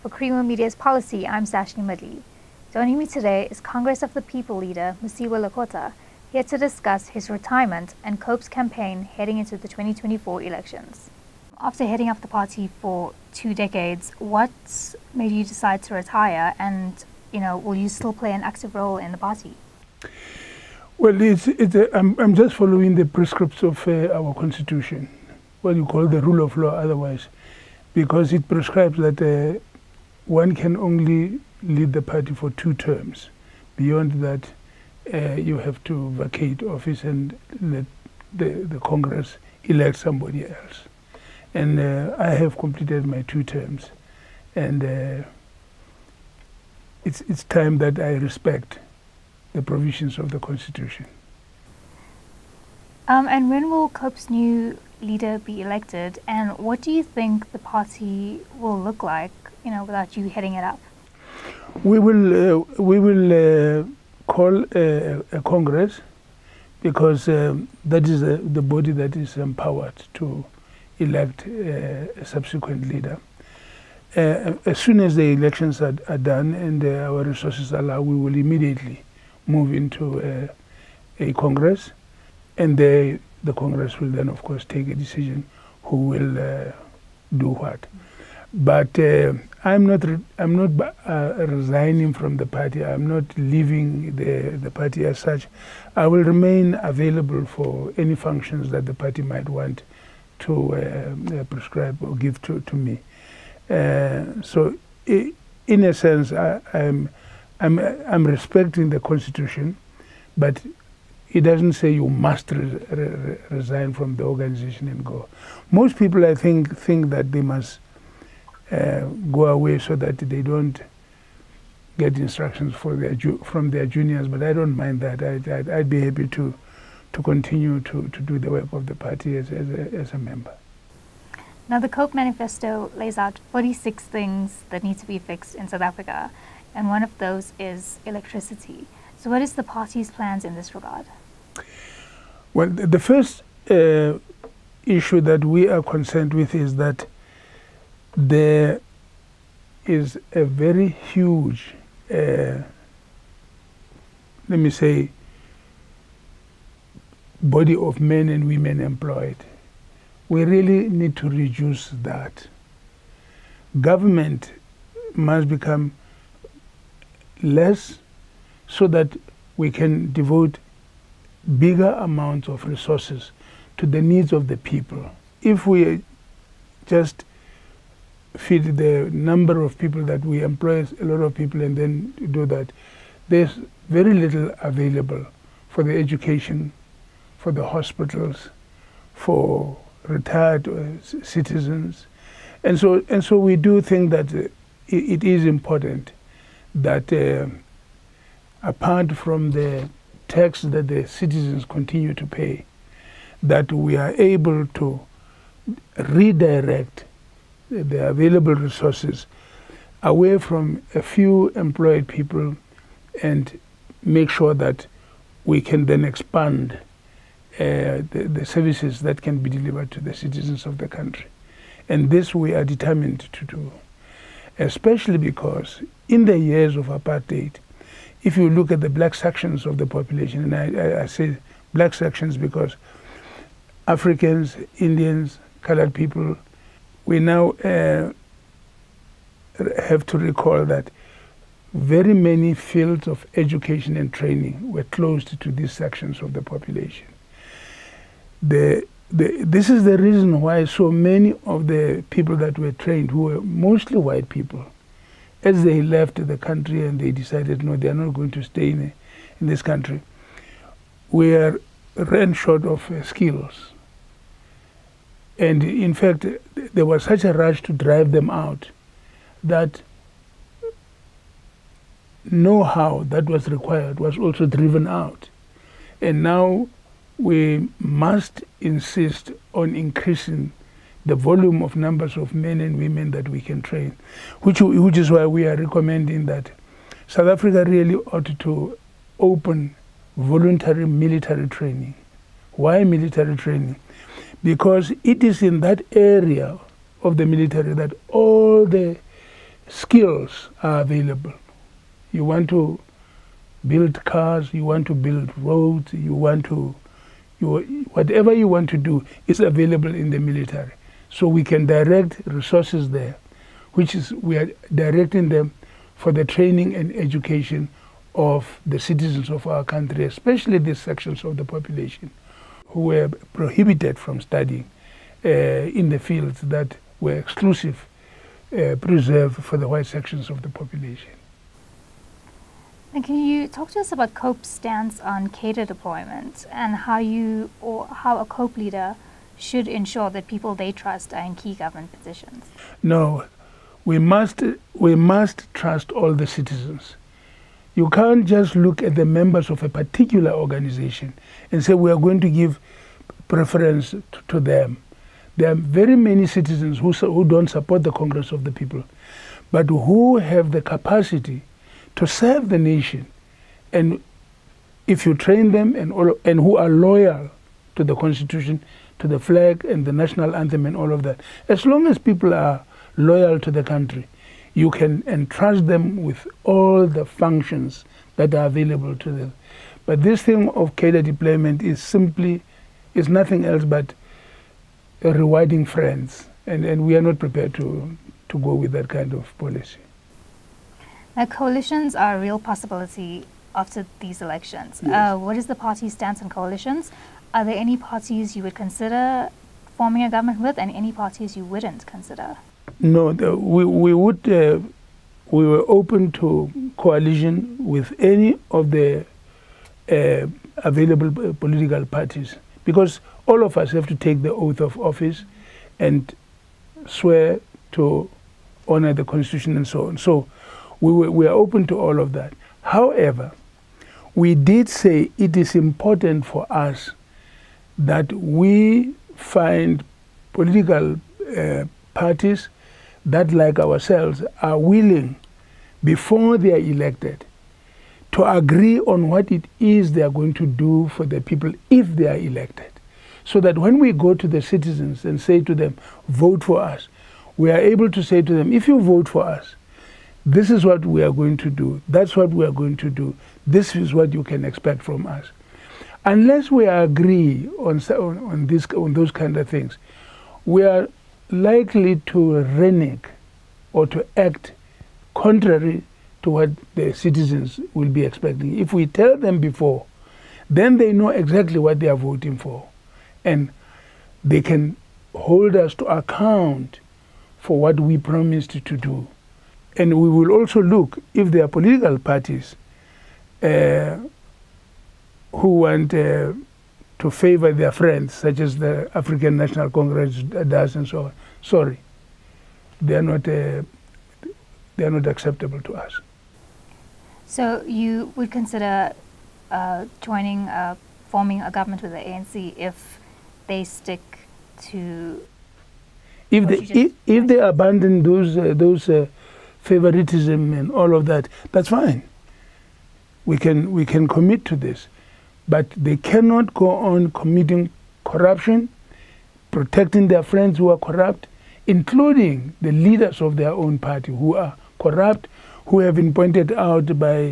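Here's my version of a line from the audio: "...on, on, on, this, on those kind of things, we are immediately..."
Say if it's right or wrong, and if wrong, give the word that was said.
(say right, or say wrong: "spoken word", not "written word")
wrong: "likely", not "immediately".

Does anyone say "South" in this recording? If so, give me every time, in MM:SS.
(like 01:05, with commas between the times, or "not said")
02:15, 04:47.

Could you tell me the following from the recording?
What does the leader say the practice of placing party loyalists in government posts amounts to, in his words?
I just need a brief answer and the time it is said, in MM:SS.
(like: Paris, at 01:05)
Rewarding friends, at 06:25.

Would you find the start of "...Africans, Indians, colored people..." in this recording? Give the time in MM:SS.
03:53.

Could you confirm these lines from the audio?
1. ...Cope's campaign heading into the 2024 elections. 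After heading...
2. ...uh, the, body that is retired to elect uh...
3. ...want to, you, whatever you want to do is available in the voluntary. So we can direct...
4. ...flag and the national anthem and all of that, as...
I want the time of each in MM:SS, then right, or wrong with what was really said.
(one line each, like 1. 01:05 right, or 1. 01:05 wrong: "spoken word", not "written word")
1. 00:08 right
2. 01:08 wrong: "empowered", not "retired"
3. 05:06 wrong: "military", not "voluntary"
4. 06:09 right.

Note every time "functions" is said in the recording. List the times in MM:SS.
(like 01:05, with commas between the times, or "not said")
01:38, 06:17.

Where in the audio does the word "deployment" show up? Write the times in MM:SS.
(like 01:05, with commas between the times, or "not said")
05:35, 06:21.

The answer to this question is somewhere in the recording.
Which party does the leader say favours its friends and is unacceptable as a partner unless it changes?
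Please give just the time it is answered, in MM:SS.
08:08.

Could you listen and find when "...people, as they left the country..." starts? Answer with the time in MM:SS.
04:14.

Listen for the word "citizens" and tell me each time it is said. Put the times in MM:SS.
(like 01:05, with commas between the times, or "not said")
03:11, 03:21, 03:40, 05:18, 05:46, 05:56, 07:24, 07:46.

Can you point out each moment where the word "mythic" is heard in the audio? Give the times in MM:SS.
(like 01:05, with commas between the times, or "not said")
not said.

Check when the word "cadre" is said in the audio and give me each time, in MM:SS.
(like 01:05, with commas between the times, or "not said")
05:35, 06:20.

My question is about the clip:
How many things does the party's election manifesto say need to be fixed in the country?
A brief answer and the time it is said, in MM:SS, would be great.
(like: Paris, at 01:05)
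46, at 02:13.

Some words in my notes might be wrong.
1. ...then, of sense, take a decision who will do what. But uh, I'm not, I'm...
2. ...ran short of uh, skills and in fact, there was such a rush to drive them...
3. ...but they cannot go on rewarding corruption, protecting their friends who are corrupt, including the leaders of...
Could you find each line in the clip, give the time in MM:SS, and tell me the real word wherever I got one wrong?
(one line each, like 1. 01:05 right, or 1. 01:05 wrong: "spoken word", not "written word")
1. 01:24 wrong: "course", not "sense"
2. 04:21 right
3. 08:35 wrong: "committing", not "rewarding".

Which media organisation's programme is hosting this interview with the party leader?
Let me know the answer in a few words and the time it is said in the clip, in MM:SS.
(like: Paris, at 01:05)
Creamer Media, at 00:00.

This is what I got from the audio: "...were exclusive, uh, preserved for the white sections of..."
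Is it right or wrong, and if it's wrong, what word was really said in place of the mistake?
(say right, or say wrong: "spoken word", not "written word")
right.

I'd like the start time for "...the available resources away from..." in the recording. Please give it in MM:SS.
03:27.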